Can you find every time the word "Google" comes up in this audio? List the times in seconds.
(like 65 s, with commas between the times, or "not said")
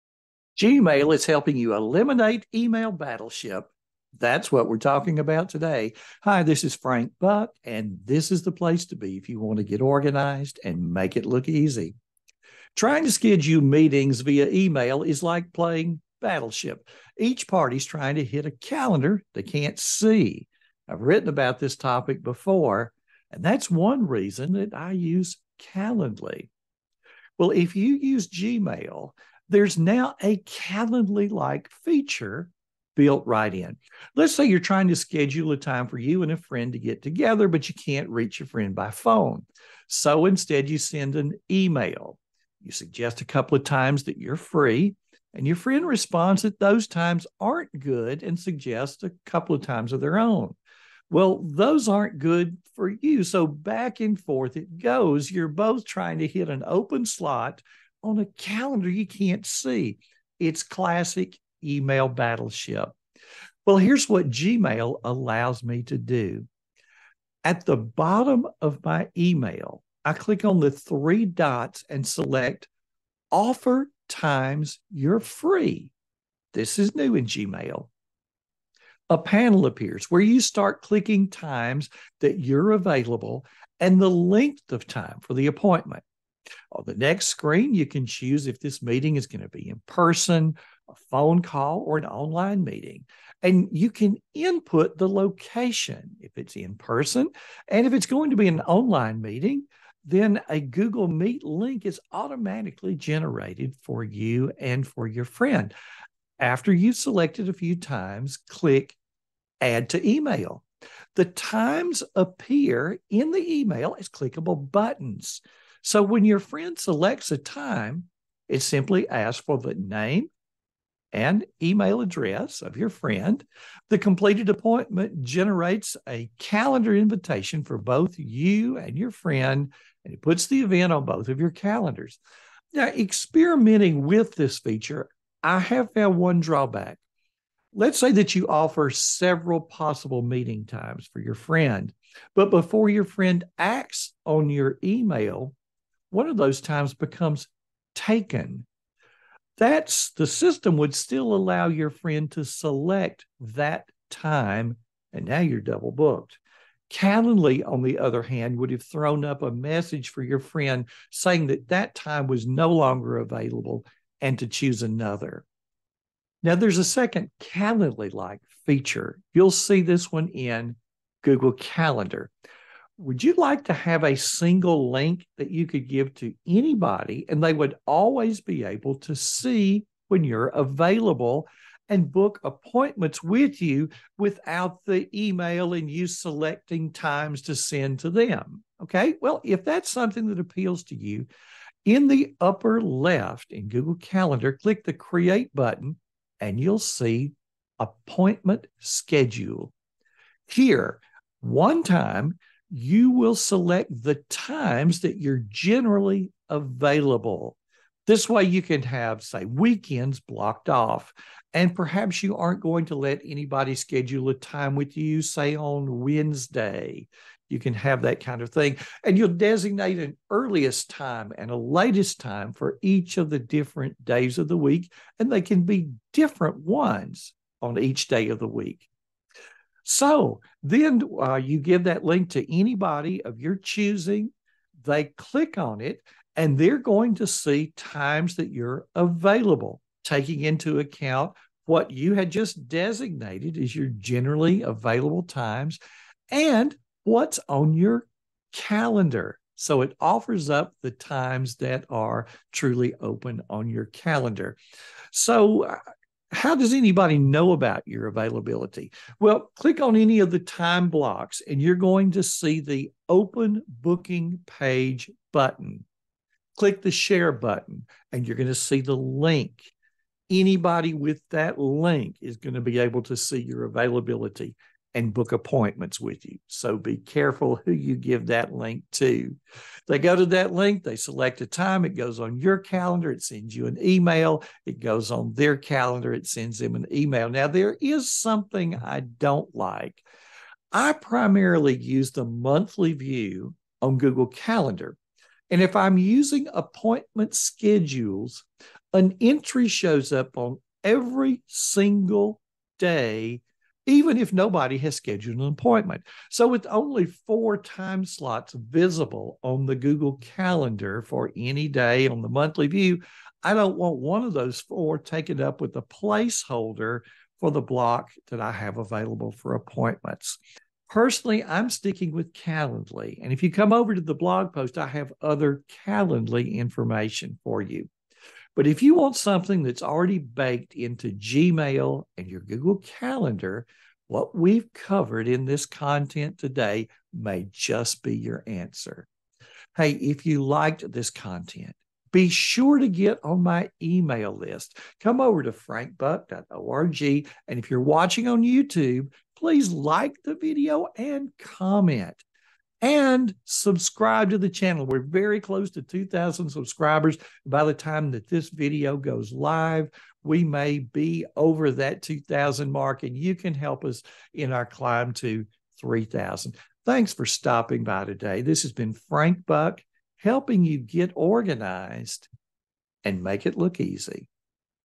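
100 s, 171 s, 193 s, 293 s, 309 s, 332 s.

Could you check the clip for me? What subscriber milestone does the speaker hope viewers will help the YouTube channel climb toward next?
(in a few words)
3,000.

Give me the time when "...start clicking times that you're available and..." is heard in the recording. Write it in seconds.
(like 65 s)
80 s.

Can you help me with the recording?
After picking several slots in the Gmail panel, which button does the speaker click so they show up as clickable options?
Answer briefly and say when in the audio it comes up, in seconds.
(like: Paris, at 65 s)
Add to Email, at 109 s.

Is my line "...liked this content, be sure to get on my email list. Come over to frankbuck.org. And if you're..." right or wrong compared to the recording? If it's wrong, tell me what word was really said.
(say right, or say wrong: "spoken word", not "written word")
right.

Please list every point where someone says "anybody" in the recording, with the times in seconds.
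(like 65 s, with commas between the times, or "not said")
176 s, 213 s, 232 s, 256 s, 270 s.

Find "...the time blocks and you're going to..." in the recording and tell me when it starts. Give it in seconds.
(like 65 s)
260 s.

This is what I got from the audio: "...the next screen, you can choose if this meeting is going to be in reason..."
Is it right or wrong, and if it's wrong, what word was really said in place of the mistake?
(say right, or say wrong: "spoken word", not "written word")
wrong: "person", not "reason".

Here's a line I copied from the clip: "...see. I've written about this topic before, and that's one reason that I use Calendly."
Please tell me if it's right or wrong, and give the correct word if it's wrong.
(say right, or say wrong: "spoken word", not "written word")
right.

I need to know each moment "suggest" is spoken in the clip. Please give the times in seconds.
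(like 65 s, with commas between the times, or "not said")
42 s, 48 s.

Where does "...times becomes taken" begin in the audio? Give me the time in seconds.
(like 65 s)
146 s.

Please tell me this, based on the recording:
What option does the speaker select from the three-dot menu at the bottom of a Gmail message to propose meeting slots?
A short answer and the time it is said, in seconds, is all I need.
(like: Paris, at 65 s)
Offer times you're free, at 73 s.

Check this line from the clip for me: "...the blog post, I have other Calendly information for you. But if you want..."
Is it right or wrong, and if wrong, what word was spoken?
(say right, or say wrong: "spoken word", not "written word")
right.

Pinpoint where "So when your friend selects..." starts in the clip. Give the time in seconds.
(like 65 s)
115 s.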